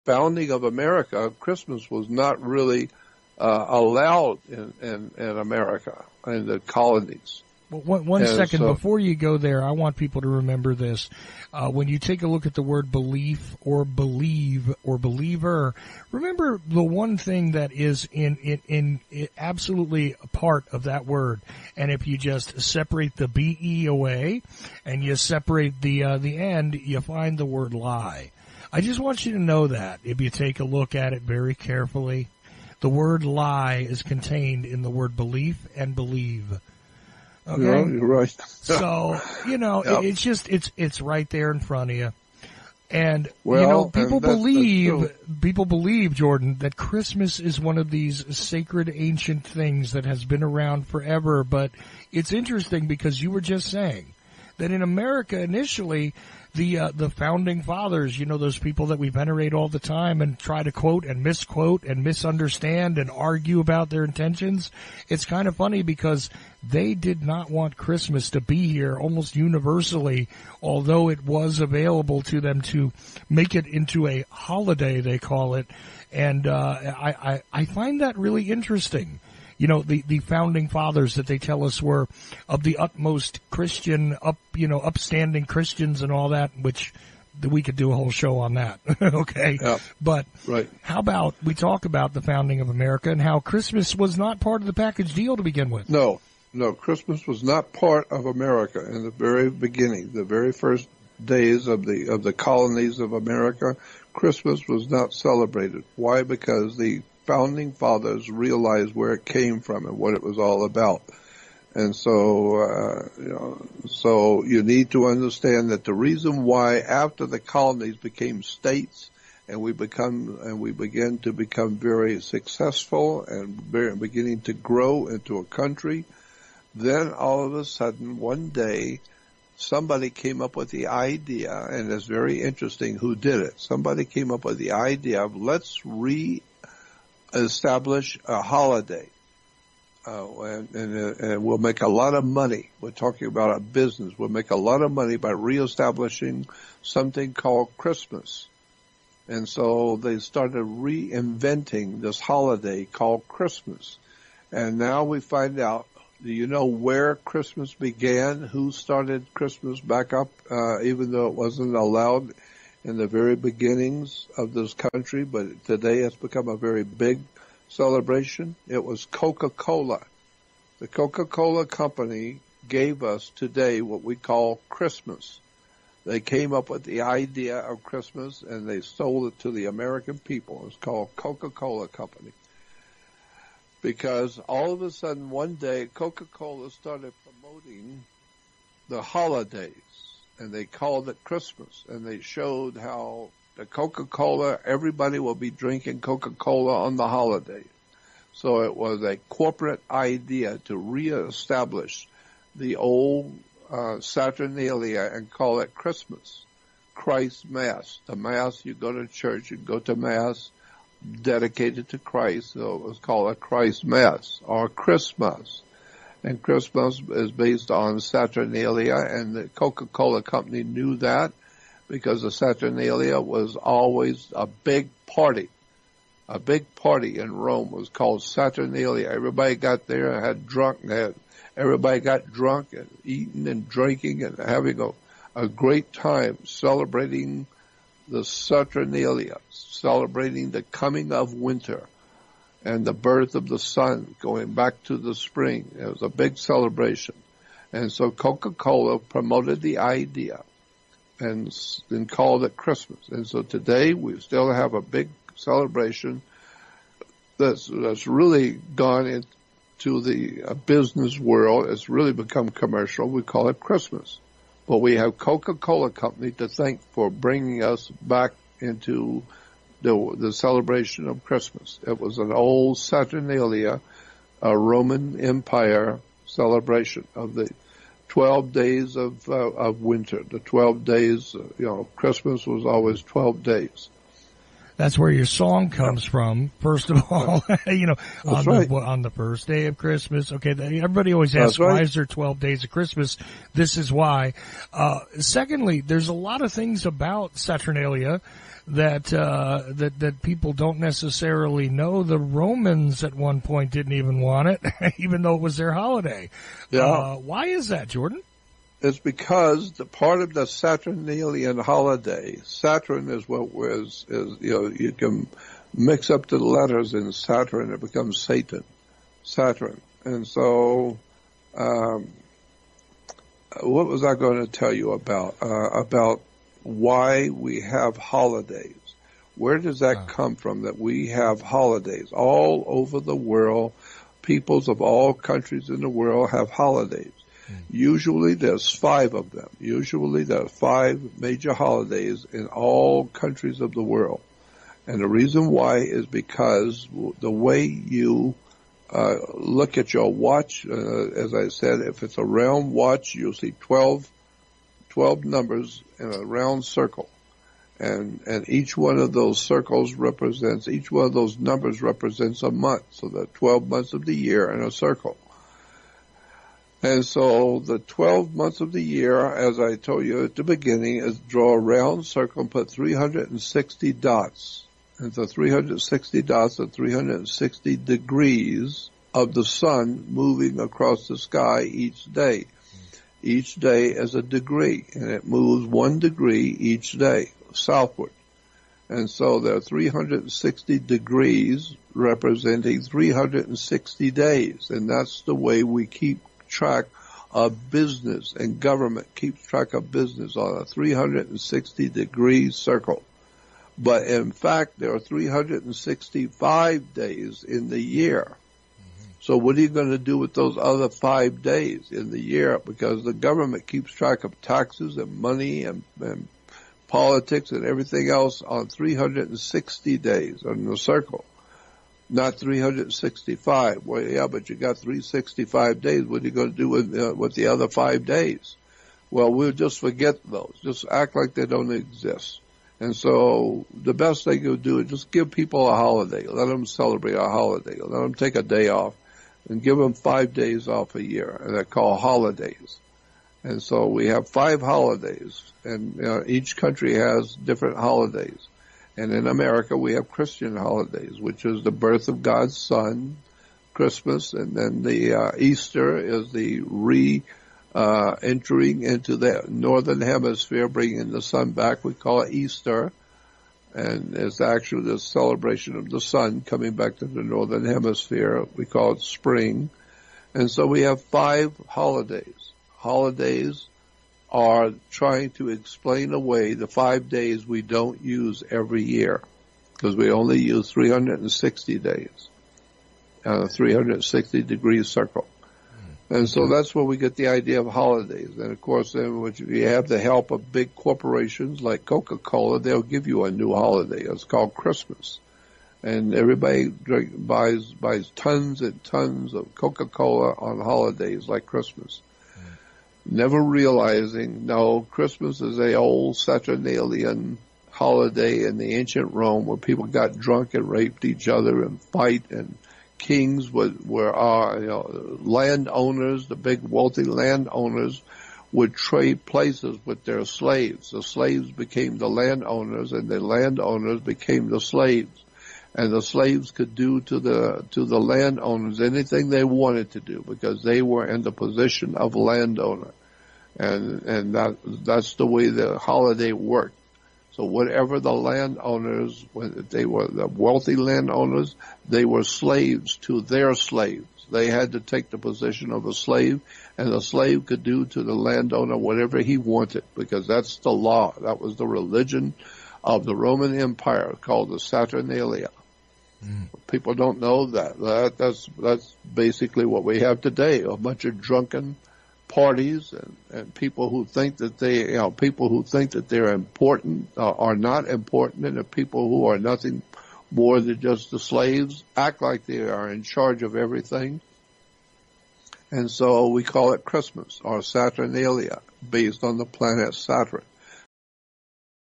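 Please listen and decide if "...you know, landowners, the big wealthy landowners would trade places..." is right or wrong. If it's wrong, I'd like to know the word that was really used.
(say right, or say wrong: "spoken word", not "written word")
right.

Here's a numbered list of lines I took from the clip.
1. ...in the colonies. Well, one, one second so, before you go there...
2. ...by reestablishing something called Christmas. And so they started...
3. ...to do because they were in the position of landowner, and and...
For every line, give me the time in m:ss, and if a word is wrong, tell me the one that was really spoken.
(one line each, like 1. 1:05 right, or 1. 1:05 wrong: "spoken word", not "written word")
1. 0:06 right
2. 2:25 right
3. 8:49 right.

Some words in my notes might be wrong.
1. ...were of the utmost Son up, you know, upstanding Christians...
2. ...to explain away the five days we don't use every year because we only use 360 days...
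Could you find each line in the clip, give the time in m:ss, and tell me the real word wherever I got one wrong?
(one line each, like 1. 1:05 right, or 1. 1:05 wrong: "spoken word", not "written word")
1. 1:21 wrong: "Christian", not "Son"
2. 7:55 right.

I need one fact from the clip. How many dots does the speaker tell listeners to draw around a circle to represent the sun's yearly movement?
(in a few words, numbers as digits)
360.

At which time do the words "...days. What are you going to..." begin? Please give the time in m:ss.
7:05.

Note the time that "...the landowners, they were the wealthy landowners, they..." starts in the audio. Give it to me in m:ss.
8:58.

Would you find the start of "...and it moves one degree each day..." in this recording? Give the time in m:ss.
6:24.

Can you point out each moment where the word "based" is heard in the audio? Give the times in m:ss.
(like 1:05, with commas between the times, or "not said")
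3:37, 9:38.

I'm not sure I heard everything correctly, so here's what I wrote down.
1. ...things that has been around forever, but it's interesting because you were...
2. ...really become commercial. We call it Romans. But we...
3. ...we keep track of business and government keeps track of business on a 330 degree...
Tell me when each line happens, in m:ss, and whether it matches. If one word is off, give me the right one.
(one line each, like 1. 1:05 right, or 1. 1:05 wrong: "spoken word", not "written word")
1. 0:49 right
2. 4:21 wrong: "Christmas", not "Romans"
3. 6:35 wrong: "360", not "330".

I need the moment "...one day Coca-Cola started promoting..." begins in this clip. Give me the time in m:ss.
3:05.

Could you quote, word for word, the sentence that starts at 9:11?
That was the religion of the Roman Empire called the Saturnalia.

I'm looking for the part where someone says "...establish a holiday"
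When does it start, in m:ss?
2:17.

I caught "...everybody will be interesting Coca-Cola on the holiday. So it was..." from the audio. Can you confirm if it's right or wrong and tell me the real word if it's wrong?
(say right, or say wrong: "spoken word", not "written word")
wrong: "drinking", not "interesting".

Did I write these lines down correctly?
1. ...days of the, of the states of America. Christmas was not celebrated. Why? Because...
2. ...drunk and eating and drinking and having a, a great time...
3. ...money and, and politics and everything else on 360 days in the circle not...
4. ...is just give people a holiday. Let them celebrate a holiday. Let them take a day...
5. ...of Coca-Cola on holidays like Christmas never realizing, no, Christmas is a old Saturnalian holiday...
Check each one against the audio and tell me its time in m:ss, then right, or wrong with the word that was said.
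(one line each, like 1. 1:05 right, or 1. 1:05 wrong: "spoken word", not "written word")
1. 1:41 wrong: "colonies", not "states"
2. 3:52 right
3. 6:55 right
4. 7:14 right
5. 8:19 right.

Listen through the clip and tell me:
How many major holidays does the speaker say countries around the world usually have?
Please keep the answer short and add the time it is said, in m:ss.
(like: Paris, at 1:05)
5, at 5:39.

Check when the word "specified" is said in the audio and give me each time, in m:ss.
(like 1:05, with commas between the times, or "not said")
not said.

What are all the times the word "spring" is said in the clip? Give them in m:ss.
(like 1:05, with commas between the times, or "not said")
4:05, 7:49.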